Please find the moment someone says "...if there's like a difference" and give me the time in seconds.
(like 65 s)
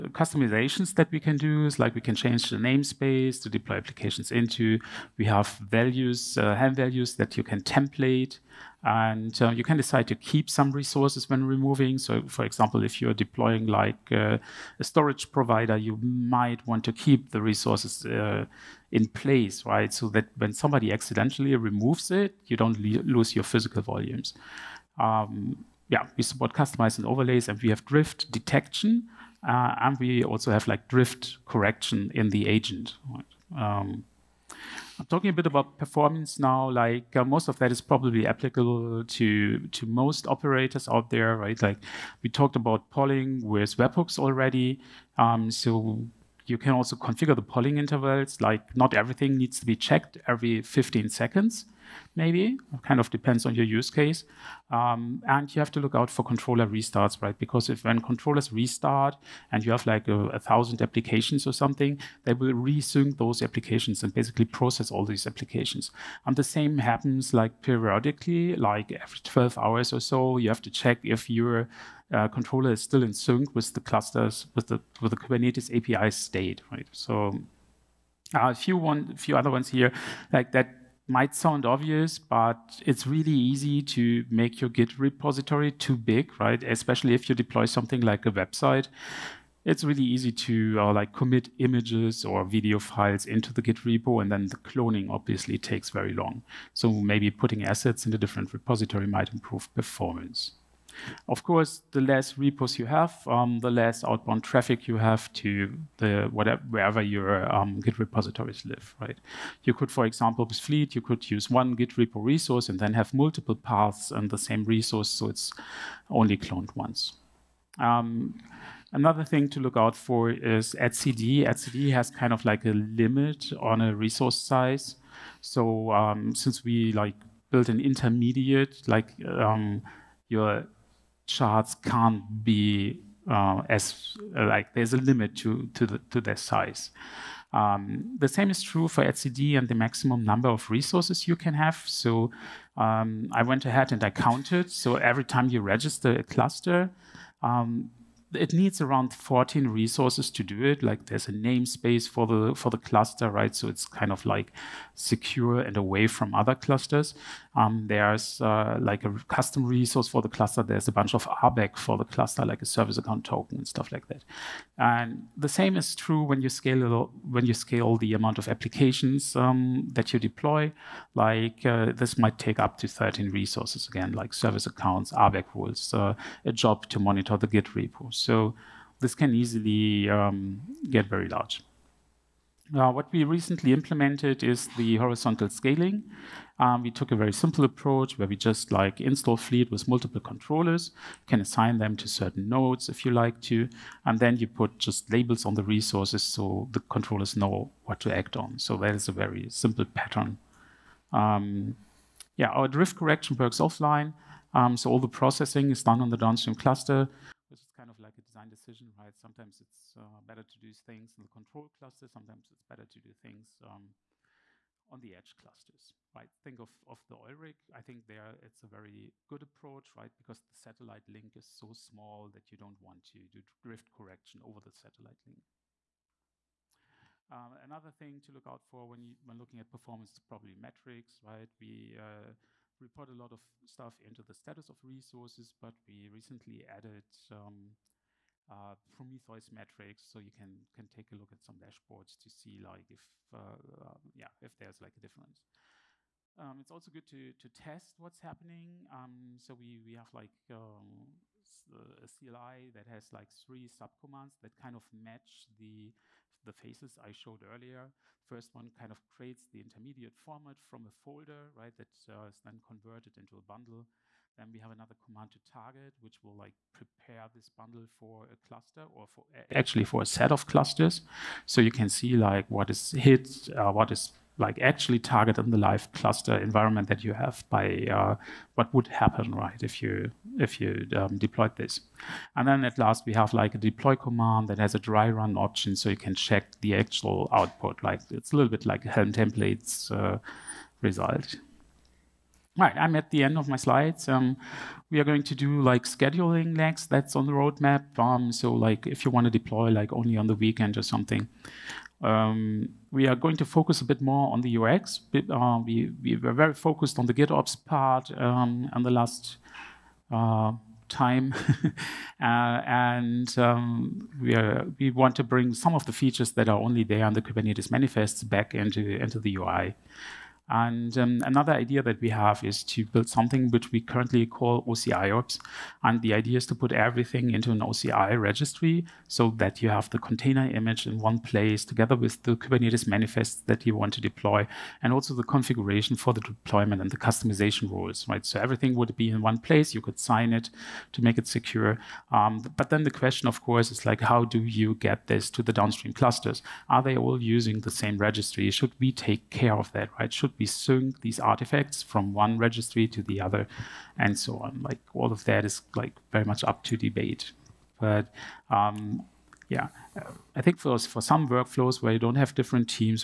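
244 s.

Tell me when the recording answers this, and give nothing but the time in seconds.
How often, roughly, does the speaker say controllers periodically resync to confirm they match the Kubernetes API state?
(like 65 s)
68 s.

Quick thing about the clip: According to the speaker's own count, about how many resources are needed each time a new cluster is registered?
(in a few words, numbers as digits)
14.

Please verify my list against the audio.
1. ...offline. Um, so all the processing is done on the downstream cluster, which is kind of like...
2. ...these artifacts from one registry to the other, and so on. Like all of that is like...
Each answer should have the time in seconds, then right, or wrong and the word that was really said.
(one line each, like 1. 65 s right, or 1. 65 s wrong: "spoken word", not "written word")
1. 203 s right
2. 351 s right.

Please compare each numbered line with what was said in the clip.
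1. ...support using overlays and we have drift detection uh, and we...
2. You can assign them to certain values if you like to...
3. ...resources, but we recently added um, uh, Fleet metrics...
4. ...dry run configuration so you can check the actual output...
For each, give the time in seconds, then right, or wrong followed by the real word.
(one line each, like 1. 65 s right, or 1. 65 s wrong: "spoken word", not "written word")
1. 26 s wrong: "customizing", not "using"
2. 191 s wrong: "nodes", not "values"
3. 234 s wrong: "Prometheus", not "Fleet"
4. 284 s wrong: "option", not "configuration".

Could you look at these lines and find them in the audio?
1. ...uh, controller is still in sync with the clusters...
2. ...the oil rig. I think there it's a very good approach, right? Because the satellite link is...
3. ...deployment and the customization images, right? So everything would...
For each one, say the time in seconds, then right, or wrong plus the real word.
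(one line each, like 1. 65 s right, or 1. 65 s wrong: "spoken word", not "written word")
1. 72 s right
2. 217 s right
3. 336 s wrong: "rules", not "images".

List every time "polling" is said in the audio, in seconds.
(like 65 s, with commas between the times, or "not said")
42 s, 47 s.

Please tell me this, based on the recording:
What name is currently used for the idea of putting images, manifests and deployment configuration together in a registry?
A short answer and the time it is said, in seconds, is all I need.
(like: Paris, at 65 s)
OCI ops, at 324 s.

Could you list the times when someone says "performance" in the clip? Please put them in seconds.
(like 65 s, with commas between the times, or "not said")
35 s, 99 s, 229 s.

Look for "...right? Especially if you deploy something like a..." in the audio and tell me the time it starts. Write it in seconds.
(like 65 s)
86 s.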